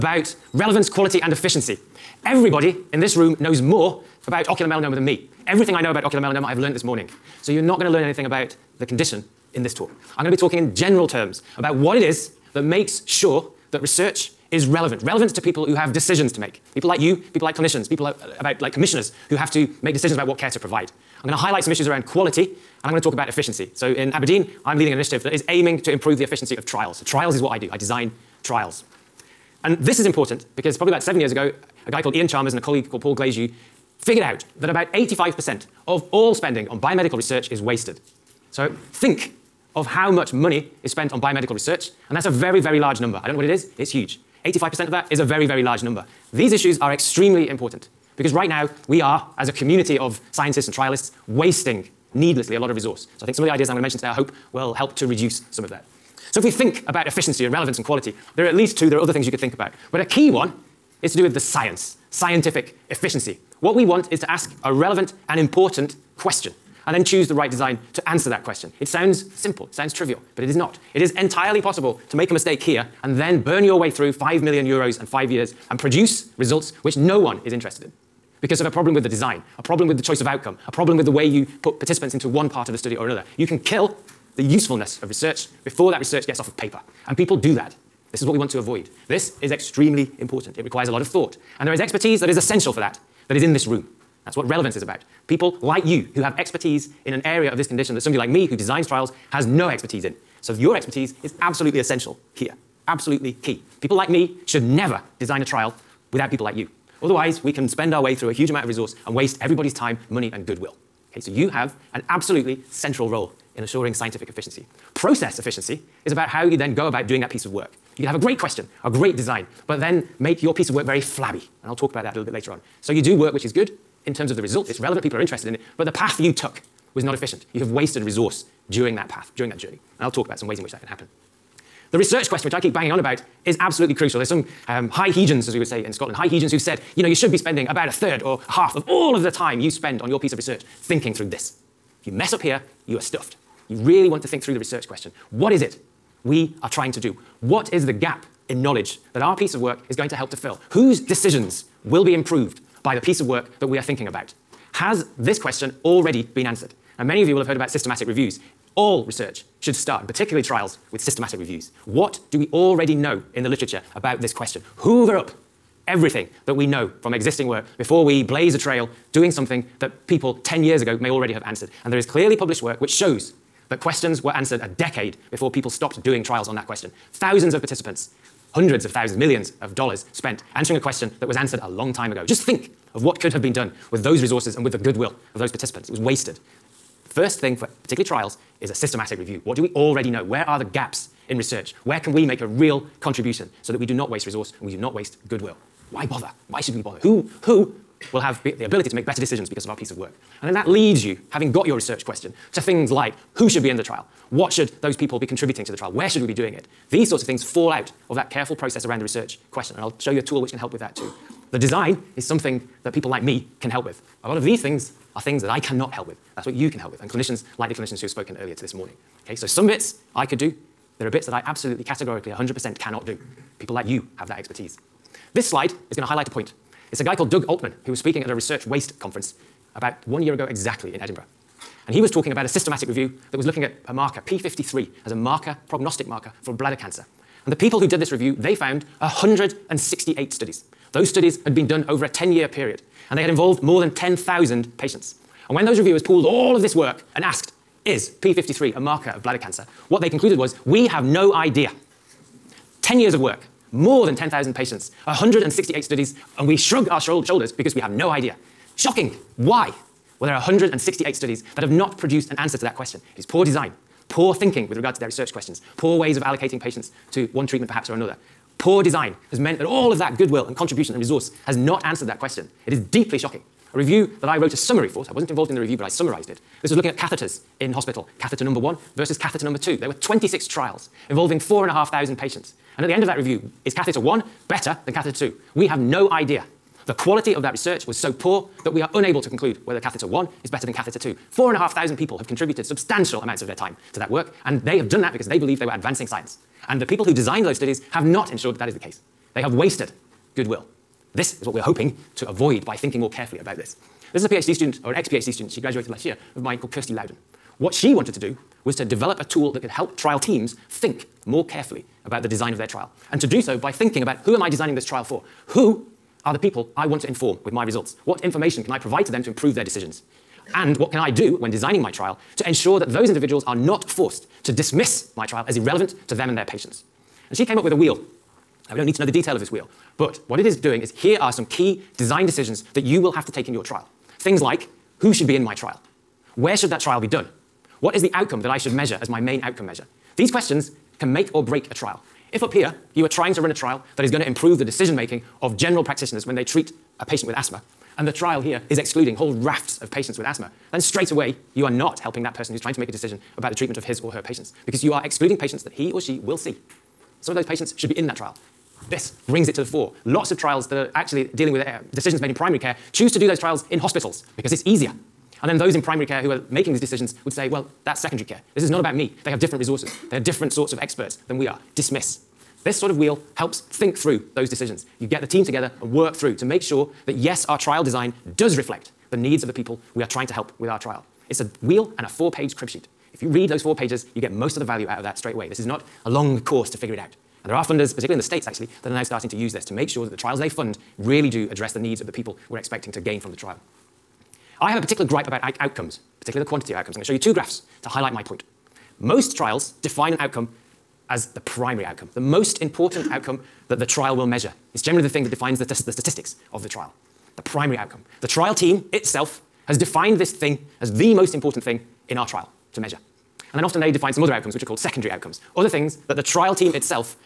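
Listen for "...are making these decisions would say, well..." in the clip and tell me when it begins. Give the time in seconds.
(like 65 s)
366 s.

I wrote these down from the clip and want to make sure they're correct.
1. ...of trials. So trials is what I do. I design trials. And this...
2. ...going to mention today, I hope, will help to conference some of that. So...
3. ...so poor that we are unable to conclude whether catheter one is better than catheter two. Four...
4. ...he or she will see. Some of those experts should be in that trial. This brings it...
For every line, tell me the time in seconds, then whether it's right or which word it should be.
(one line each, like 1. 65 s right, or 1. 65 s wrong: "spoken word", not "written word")
1. 26 s right
2. 53 s wrong: "reduce", not "conference"
3. 287 s right
4. 355 s wrong: "patients", not "experts".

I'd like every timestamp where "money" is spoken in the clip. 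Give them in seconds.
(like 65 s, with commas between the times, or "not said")
40 s, 110 s.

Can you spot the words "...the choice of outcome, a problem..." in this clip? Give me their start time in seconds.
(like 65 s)
79 s.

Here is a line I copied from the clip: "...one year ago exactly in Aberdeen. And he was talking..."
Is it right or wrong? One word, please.
wrong.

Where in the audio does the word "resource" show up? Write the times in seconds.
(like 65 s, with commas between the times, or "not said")
52 s, 108 s, 128 s, 184 s, 194 s, 270 s, 369 s.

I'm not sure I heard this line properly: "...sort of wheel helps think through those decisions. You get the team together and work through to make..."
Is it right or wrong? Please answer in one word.
right.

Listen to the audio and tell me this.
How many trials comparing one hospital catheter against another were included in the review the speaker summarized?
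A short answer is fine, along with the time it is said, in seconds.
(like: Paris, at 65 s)
26, at 279 s.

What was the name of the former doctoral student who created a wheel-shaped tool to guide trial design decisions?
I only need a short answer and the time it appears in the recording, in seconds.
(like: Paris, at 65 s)
Kirsty Loudon, at 306 s.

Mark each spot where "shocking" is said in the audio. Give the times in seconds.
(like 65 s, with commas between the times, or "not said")
258 s, 273 s.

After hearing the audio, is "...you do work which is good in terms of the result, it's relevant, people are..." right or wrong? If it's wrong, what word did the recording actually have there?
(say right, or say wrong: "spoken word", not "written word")
right.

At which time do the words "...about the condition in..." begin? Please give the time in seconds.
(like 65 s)
8 s.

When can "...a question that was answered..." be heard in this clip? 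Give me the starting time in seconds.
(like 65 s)
180 s.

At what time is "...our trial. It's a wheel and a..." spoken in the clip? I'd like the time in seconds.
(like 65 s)
380 s.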